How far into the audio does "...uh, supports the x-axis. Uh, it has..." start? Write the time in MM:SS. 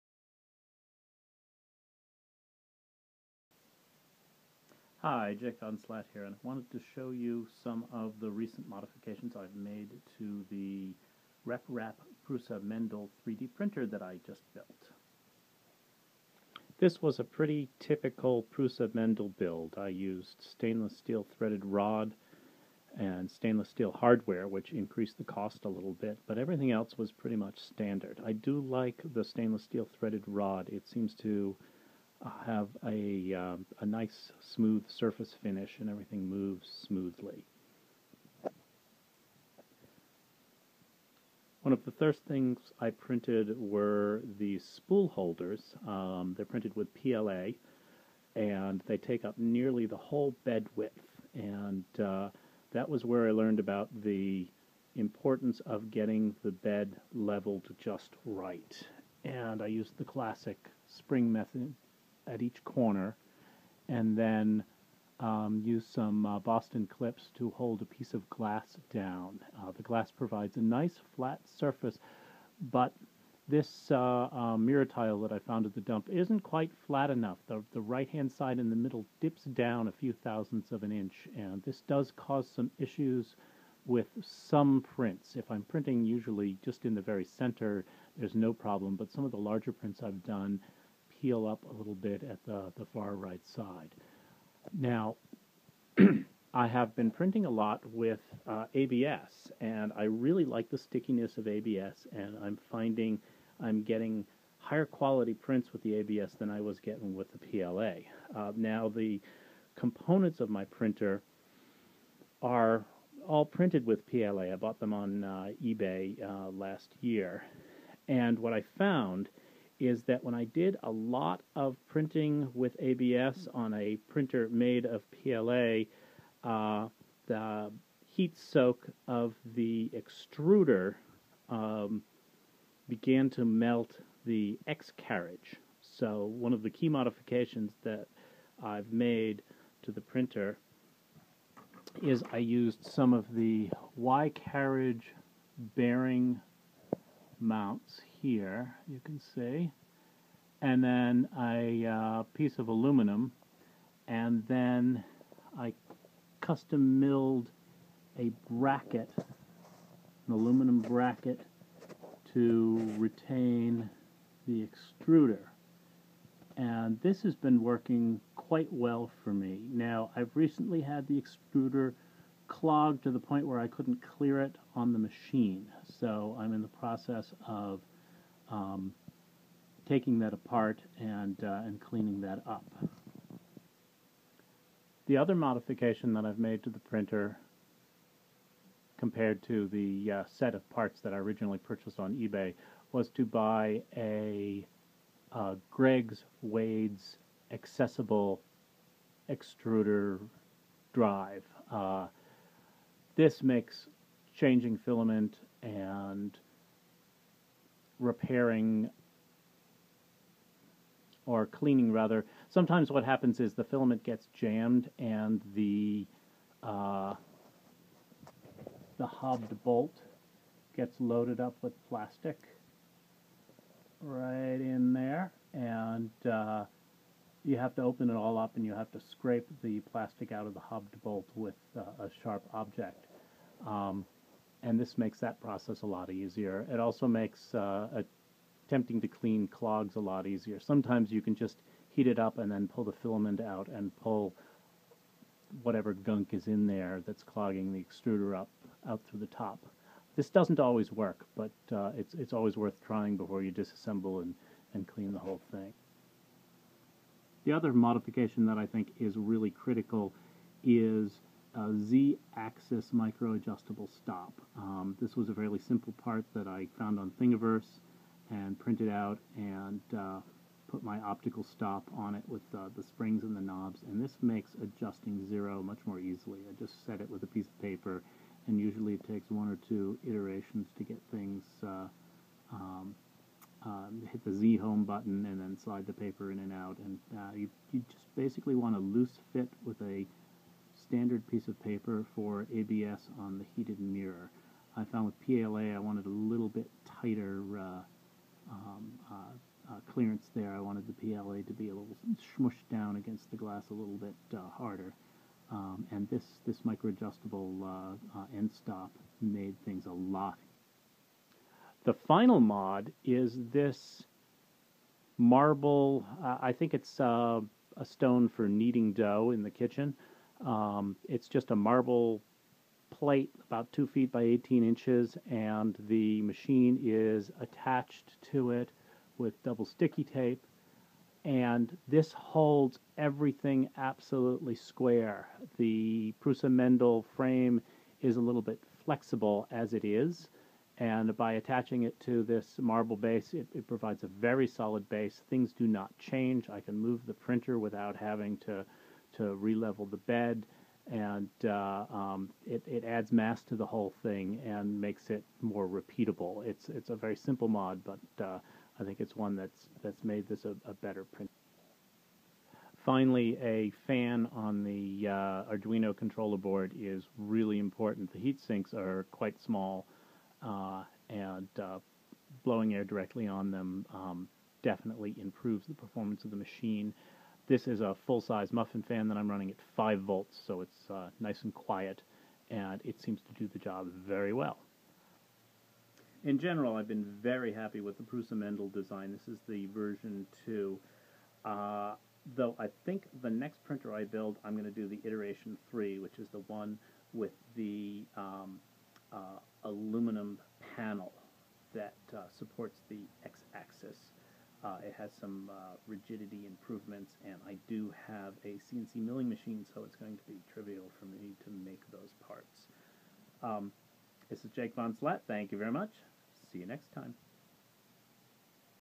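06:42.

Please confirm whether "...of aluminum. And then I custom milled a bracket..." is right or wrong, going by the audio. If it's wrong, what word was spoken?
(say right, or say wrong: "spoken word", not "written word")
right.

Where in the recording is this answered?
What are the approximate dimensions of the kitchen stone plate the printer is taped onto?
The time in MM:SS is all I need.
05:23.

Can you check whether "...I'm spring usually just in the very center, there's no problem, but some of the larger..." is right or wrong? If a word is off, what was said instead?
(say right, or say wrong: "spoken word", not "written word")
wrong: "printing", not "spring".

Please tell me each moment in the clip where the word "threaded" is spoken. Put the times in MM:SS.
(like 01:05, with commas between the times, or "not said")
00:21, 00:29.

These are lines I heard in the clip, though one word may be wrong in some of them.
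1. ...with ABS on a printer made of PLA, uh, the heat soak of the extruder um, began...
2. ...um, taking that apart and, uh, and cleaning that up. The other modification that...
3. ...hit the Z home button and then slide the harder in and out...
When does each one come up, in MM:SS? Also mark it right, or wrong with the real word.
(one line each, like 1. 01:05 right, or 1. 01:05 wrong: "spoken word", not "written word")
1. 02:02 right
2. 02:58 right
3. 04:44 wrong: "paper", not "harder".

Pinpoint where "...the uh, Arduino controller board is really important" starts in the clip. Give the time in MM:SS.
06:04.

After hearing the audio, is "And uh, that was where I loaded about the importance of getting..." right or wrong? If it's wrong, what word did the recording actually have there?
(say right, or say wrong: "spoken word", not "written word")
wrong: "learned", not "loaded".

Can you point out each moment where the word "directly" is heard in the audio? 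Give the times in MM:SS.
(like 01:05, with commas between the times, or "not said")
06:12.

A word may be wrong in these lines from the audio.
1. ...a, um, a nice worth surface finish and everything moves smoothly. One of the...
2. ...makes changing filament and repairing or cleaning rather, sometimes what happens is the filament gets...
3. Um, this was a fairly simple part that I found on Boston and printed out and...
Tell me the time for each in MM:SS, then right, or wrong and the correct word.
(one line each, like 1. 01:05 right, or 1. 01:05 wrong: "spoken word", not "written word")
1. 00:32 wrong: "smooth", not "worth"
2. 03:23 right
3. 04:24 wrong: "Thingiverse", not "Boston".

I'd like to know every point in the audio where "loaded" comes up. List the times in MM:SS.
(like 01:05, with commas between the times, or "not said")
03:40.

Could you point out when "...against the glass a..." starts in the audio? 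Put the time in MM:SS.
05:02.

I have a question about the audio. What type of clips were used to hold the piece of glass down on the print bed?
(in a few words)
Boston clips.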